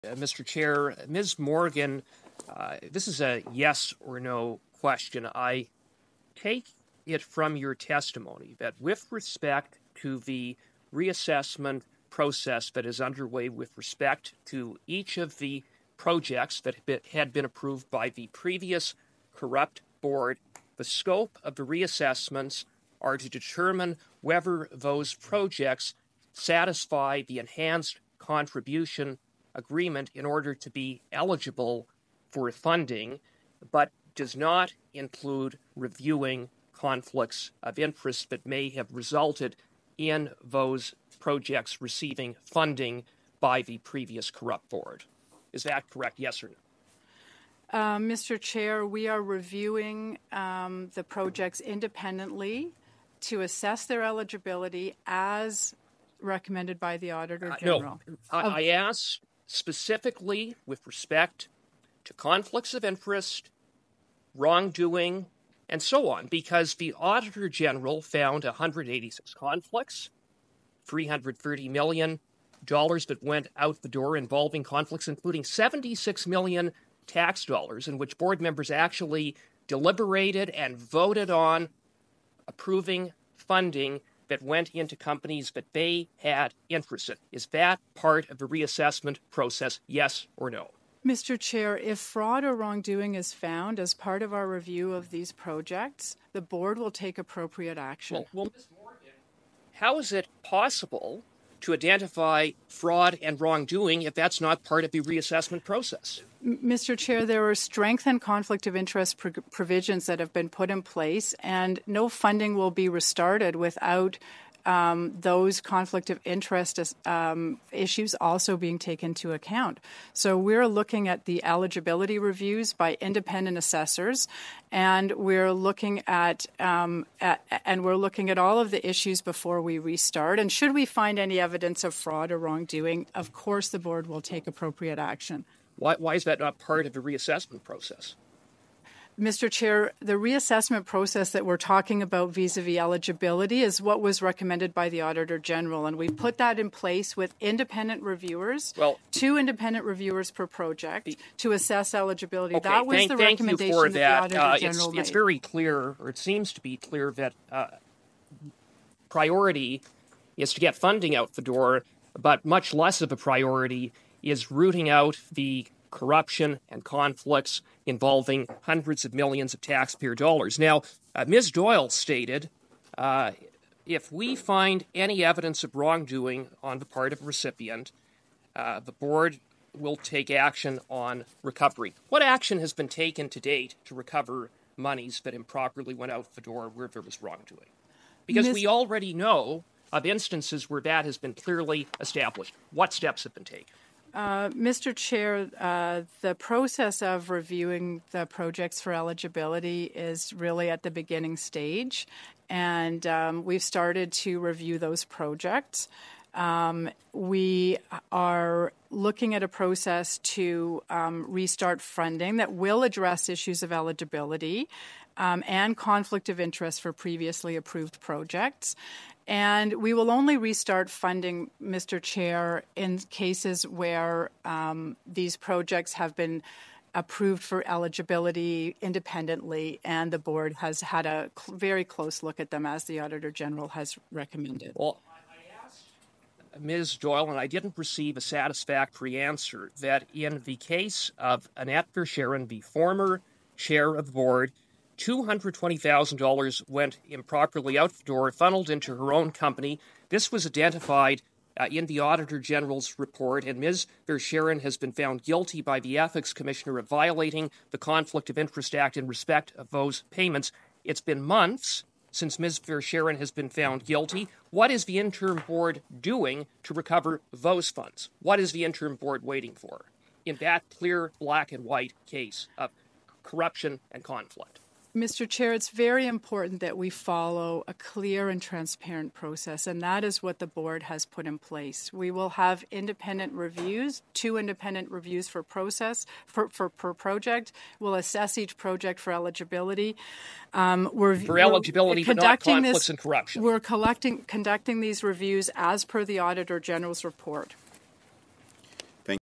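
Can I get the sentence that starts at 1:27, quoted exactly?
Is that part of the reassessment process, yes or no?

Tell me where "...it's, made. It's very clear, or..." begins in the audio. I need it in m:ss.
2:34.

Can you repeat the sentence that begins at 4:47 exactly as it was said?
We'll assess each project for eligibility.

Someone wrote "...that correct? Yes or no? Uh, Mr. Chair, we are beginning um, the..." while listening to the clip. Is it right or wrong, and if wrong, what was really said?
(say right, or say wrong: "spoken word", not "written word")
wrong: "reviewing", not "beginning".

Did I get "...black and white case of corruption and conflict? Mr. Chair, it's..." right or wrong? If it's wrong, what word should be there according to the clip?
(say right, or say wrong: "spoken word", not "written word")
right.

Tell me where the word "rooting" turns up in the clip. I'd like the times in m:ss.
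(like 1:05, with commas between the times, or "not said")
2:44.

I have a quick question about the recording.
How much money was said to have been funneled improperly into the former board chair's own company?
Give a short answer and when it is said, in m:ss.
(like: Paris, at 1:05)
$220,000, at 4:05.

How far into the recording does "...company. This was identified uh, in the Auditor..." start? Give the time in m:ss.
4:09.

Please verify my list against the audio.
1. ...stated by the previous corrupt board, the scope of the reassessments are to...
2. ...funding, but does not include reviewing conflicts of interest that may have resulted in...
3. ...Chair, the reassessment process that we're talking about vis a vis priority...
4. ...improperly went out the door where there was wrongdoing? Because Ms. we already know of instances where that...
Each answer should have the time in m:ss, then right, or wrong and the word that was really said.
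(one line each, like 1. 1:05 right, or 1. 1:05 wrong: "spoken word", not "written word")
1. 0:17 wrong: "approved", not "stated"
2. 0:32 right
3. 2:19 wrong: "eligibility", not "priority"
4. 3:05 right.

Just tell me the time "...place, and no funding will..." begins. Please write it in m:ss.
1:50.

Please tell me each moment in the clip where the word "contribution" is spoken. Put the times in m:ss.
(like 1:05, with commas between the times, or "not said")
0:28.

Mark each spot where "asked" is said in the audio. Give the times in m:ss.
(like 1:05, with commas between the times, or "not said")
0:58, 3:55.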